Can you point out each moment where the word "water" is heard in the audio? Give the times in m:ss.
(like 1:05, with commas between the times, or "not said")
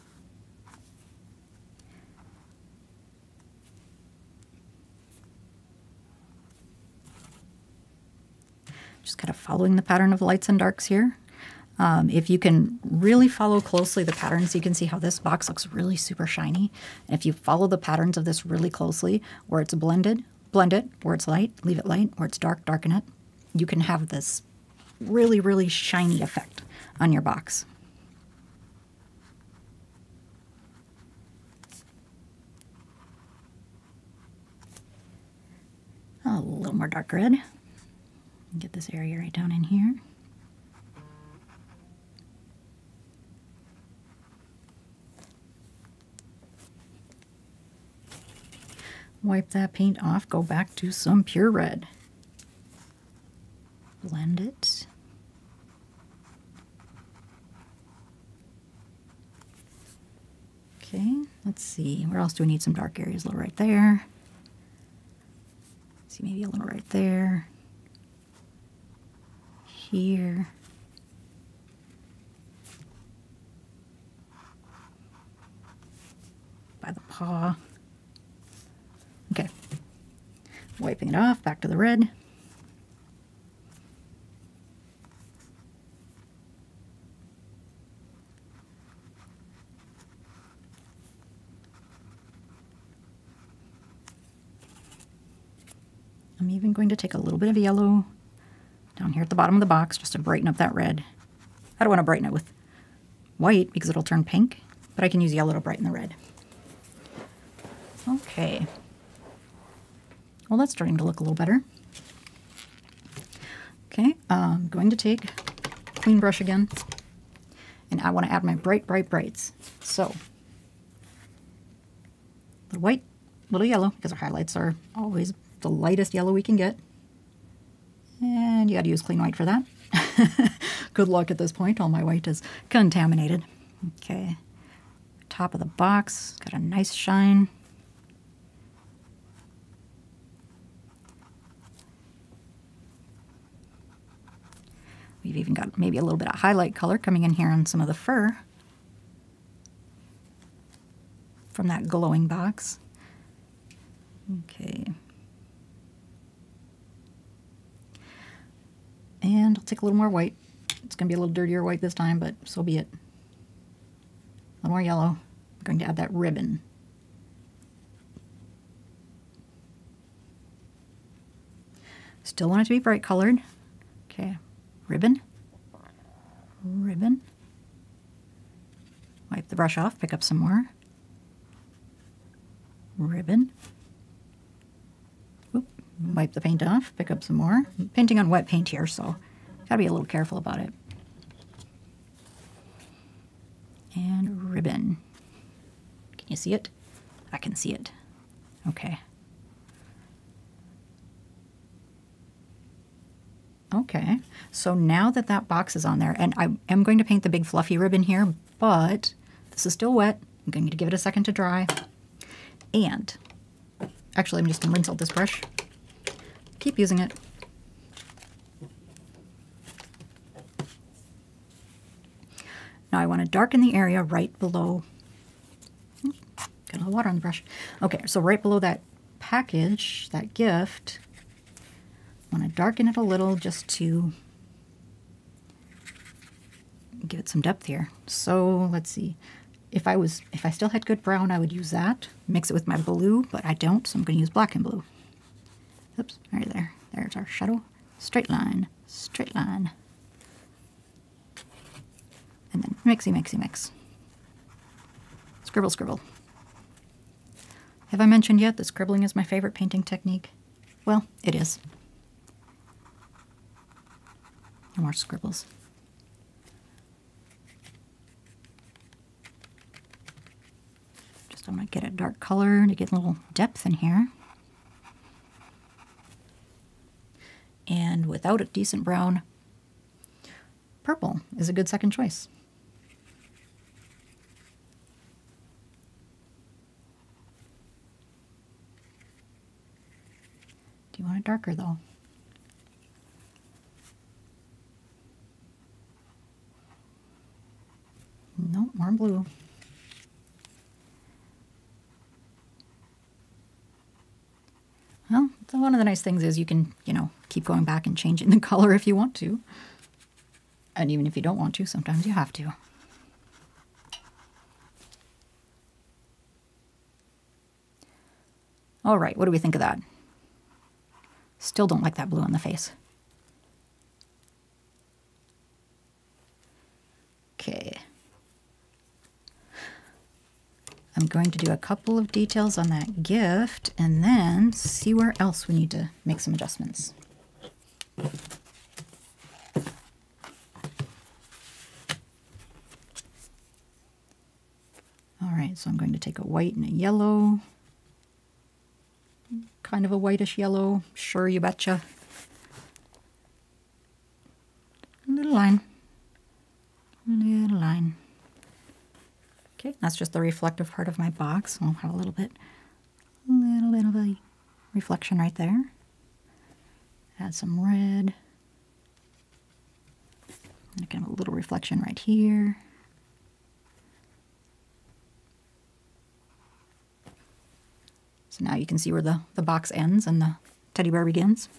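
3:46.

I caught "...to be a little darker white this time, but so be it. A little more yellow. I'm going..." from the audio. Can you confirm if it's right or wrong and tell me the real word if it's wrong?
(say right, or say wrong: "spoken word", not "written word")
wrong: "dirtier", not "darker".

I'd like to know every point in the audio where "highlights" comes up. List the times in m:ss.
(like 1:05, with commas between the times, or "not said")
2:04, 2:26.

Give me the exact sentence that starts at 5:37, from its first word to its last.
All right, so I'm going to take a white and a yellow.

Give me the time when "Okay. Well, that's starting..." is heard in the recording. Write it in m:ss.
1:48.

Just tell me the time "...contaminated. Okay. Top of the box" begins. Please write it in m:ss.
2:12.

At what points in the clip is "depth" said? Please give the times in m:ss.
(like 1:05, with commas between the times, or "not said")
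3:57, 4:33.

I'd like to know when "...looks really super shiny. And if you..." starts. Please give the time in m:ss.
0:15.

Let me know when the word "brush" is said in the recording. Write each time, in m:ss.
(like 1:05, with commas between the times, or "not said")
1:56, 2:59, 3:35, 3:47.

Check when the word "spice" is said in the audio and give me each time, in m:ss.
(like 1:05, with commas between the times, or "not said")
not said.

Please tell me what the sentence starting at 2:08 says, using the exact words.
And you got to use clean white for that.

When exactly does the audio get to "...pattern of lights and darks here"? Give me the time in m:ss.
0:09.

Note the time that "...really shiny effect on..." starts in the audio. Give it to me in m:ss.
0:25.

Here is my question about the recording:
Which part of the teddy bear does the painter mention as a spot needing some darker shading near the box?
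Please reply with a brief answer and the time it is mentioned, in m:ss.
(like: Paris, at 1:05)
The paw, at 1:16.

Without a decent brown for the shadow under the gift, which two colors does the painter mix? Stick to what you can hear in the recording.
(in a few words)
Black and blue.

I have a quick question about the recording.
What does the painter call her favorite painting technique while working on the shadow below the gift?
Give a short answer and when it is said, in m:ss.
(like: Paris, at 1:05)
Scribbling, at 4:18.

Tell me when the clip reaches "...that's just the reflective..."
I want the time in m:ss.
5:59.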